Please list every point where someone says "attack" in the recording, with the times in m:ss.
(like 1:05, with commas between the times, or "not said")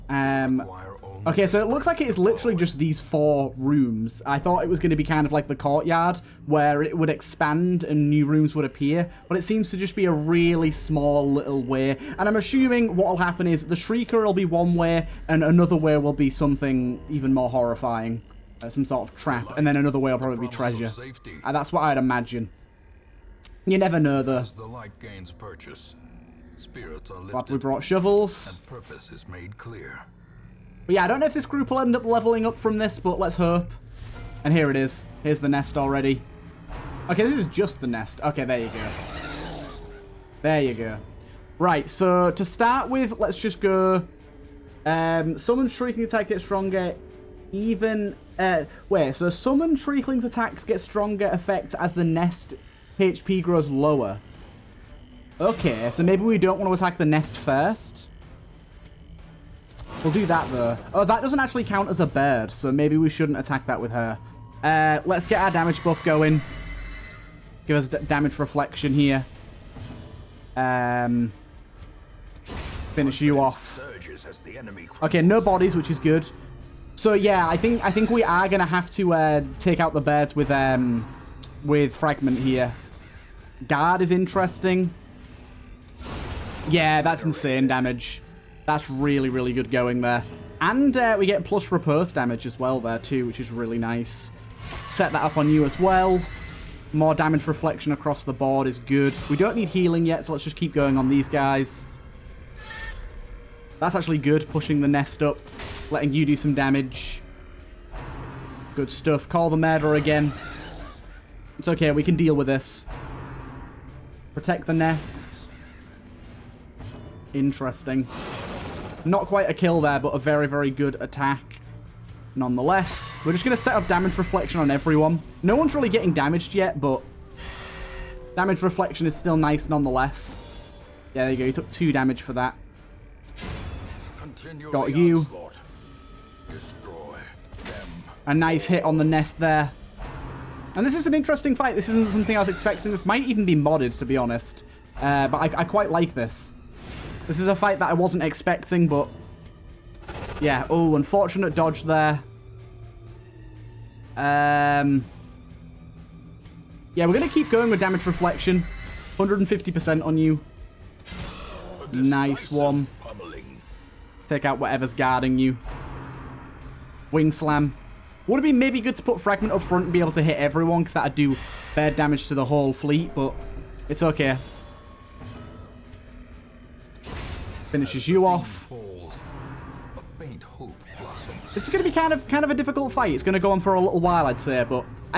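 0:46, 0:50, 0:56, 1:03, 2:00.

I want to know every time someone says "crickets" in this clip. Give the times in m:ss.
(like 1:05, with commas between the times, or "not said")
not said.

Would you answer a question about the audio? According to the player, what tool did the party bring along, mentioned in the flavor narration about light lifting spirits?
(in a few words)
Shovels.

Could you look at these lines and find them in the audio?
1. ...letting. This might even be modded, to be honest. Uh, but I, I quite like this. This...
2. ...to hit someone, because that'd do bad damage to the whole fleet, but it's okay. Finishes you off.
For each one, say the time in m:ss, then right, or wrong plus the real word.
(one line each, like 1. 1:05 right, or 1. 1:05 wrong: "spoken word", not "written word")
1. 2:22 wrong: "expecting", not "letting"
2. 2:50 wrong: "everyone", not "someone".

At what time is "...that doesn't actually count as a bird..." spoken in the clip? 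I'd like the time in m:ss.
1:01.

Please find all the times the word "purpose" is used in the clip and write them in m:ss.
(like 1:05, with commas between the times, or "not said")
0:28.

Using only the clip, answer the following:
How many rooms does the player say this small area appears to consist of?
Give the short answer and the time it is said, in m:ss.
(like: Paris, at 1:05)
4, at 0:02.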